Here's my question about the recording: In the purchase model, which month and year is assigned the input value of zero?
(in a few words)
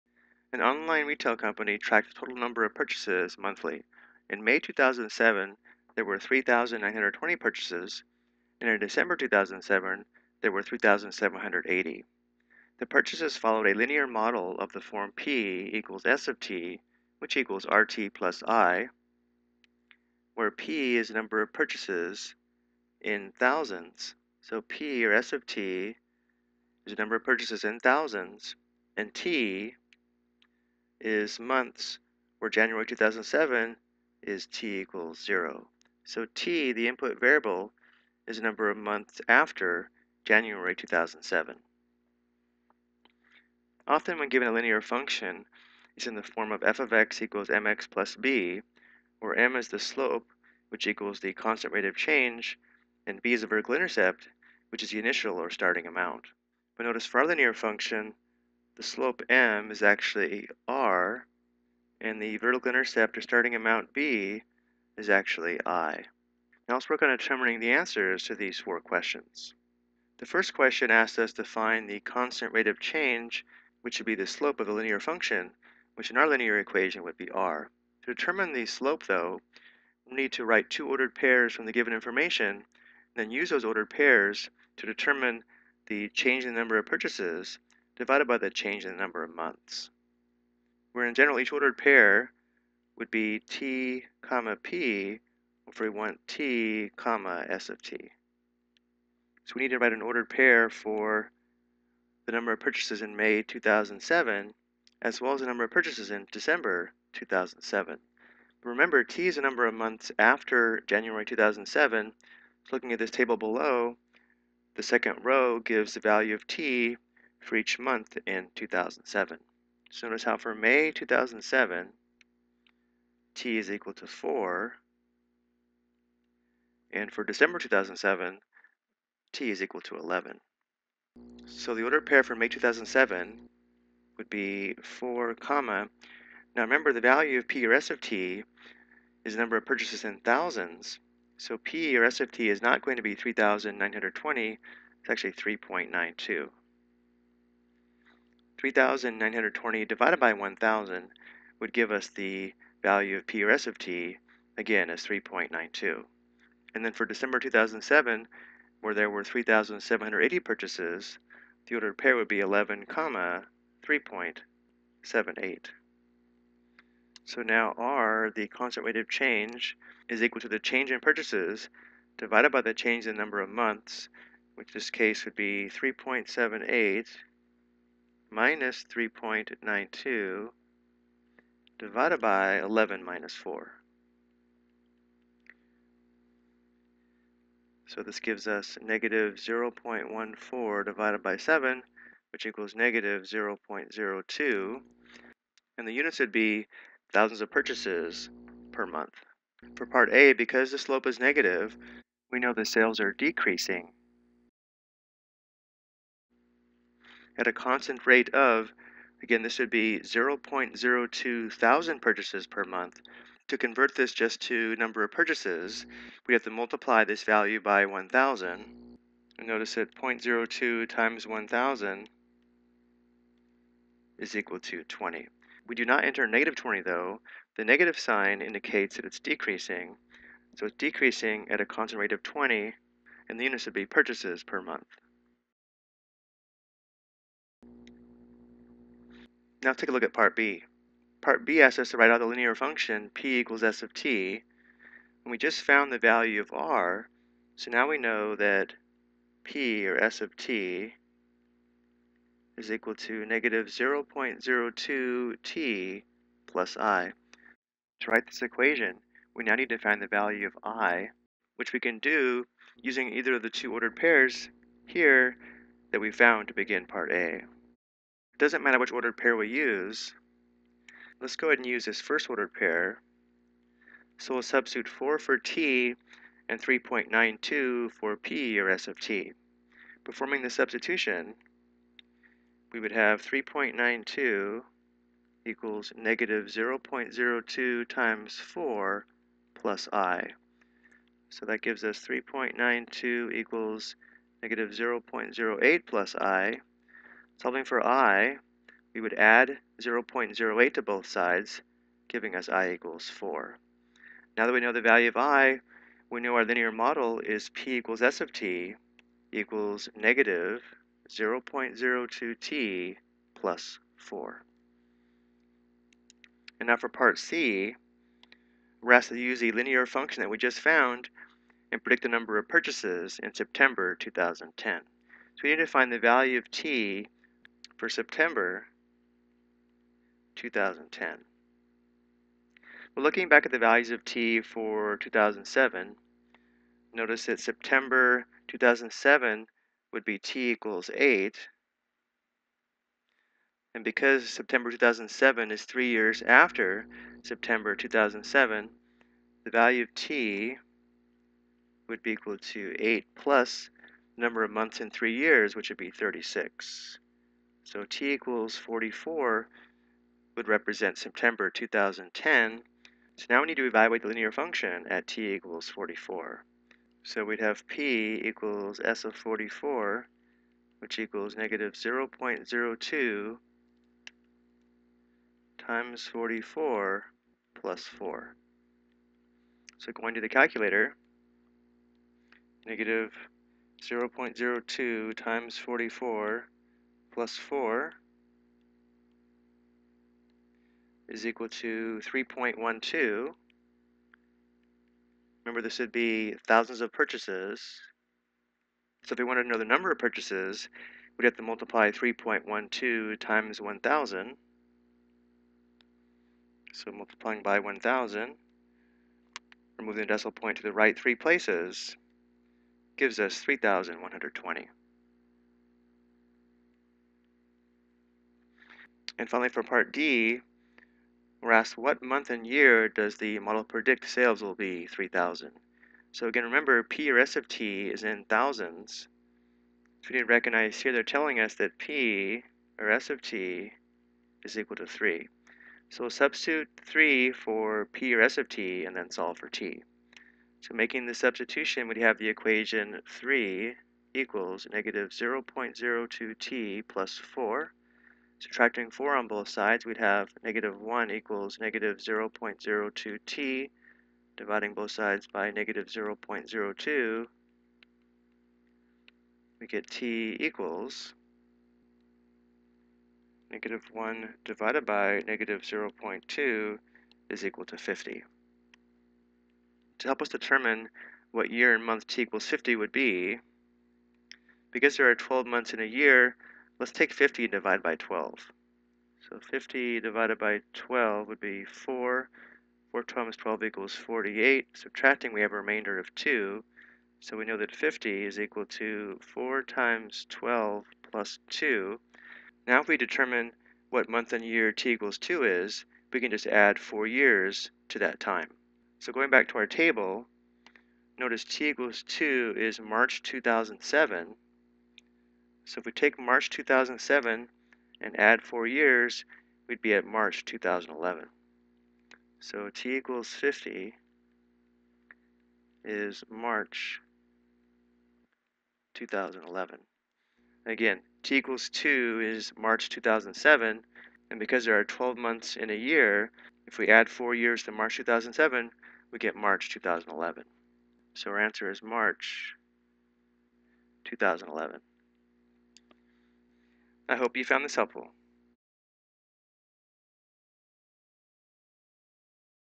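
January 2007.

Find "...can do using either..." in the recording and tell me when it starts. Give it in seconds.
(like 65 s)
261 s.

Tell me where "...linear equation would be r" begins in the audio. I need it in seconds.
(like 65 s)
76 s.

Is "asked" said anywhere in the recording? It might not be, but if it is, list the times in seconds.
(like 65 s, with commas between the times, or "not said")
70 s, 318 s, 421 s.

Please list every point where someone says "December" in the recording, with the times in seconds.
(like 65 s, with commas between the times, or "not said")
8 s, 106 s, 127 s, 157 s.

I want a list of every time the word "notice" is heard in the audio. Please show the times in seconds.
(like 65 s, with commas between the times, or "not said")
56 s, 120 s, 219 s, 336 s, 501 s.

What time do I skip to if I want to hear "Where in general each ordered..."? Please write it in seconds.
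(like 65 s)
90 s.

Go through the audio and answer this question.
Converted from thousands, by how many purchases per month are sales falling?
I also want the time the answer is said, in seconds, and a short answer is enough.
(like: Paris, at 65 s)
20, at 224 s.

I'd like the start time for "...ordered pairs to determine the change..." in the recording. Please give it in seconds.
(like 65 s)
83 s.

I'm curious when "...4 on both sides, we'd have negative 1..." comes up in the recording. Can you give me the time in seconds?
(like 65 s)
448 s.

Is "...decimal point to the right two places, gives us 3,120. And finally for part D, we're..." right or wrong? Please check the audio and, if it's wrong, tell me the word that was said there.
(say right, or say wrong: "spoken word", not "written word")
wrong: "three", not "two".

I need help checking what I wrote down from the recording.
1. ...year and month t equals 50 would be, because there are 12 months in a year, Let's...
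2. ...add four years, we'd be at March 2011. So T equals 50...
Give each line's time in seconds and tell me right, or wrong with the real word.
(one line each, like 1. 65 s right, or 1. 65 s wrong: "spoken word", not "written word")
1. 471 s right
2. 508 s right.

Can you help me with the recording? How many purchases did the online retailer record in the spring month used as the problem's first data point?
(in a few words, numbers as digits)
3,920.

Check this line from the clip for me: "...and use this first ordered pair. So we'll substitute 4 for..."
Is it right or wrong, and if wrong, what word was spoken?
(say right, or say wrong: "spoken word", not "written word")
right.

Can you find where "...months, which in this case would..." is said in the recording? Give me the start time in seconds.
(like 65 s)
173 s.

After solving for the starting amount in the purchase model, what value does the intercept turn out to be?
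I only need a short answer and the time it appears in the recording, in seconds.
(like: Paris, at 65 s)
4, at 302 s.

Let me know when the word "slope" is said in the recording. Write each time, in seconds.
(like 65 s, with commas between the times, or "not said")
49 s, 58 s, 74 s, 78 s, 200 s.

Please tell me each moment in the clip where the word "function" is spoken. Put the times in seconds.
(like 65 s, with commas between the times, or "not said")
44 s, 57 s, 74 s, 242 s, 319 s, 364 s.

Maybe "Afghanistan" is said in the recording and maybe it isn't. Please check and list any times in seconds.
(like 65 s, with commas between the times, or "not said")
not said.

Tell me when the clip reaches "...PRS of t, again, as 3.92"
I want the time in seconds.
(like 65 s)
153 s.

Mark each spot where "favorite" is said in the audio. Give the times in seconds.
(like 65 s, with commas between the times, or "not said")
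not said.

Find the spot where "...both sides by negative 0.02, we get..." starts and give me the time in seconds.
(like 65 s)
454 s.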